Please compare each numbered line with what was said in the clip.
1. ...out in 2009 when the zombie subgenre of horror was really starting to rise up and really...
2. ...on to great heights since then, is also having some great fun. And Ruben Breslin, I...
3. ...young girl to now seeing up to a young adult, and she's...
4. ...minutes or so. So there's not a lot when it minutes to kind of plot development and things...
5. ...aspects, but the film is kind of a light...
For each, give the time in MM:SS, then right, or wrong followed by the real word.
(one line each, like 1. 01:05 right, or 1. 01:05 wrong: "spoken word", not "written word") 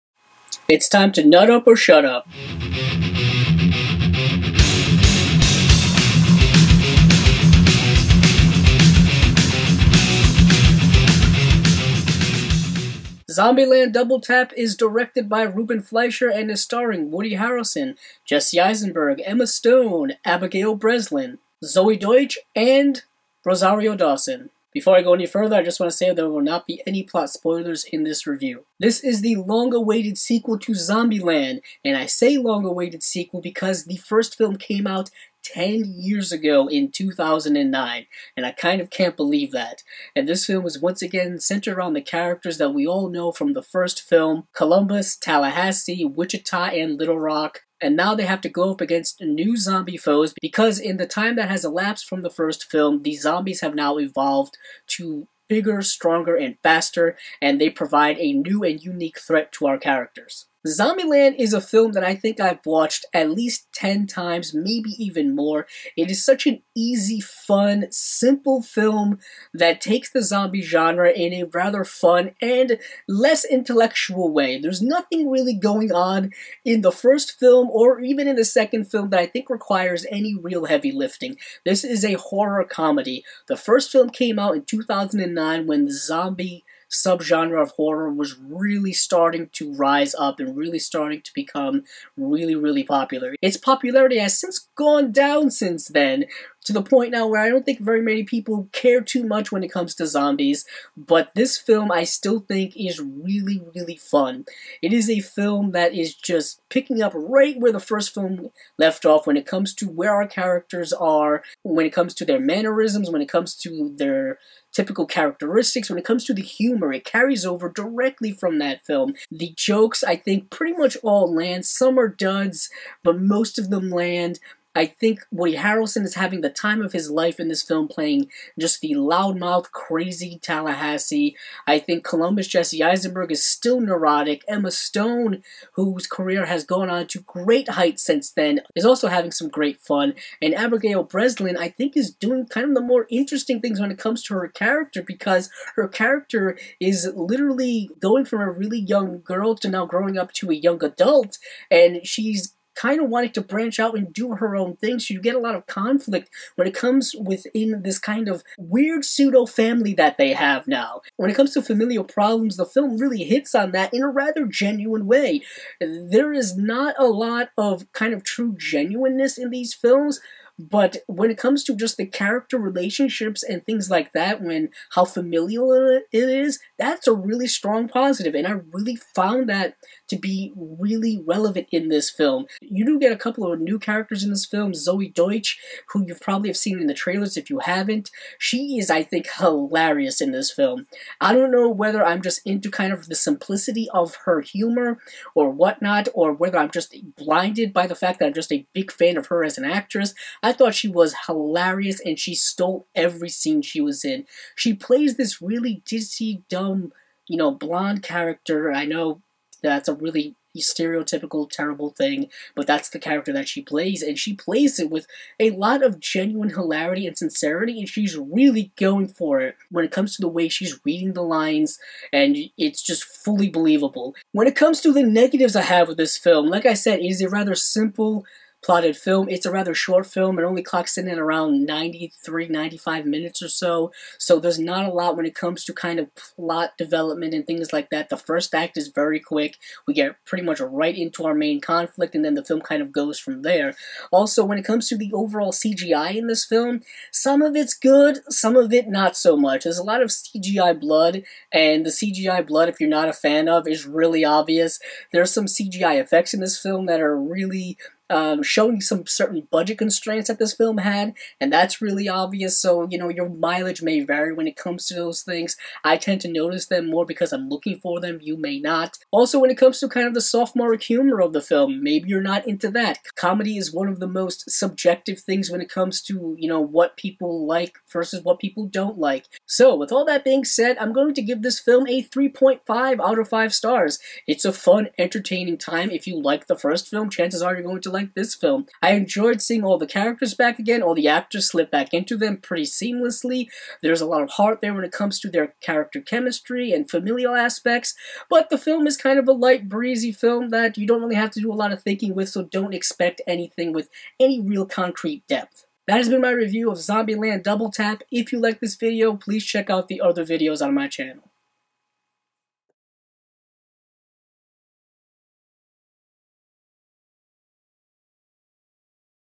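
1. 01:24 right
2. 02:16 wrong: "Abigail", not "Ruben"
3. 02:28 wrong: "growing", not "seeing"
4. 03:53 wrong: "comes", not "minutes"
5. 04:57 right.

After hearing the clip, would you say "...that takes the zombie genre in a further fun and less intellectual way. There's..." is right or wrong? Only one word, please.
wrong.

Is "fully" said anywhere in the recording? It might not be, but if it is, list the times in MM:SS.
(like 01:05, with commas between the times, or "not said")
03:43.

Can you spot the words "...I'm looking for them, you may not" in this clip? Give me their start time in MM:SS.
04:27.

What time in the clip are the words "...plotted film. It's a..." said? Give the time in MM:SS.
03:48.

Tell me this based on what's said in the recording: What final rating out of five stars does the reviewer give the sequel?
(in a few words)
3.5.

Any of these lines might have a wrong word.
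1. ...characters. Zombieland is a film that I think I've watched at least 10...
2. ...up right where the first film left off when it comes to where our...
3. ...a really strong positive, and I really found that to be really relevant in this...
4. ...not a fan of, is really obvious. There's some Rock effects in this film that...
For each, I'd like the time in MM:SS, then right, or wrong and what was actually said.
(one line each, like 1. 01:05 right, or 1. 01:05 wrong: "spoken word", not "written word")
1. 00:59 right
2. 01:47 right
3. 02:57 right
4. 04:12 wrong: "CGI", not "Rock".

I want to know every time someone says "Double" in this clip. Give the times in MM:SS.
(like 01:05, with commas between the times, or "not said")
00:13, 05:07.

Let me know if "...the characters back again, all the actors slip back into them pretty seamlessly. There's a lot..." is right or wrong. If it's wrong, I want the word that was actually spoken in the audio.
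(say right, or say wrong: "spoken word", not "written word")
right.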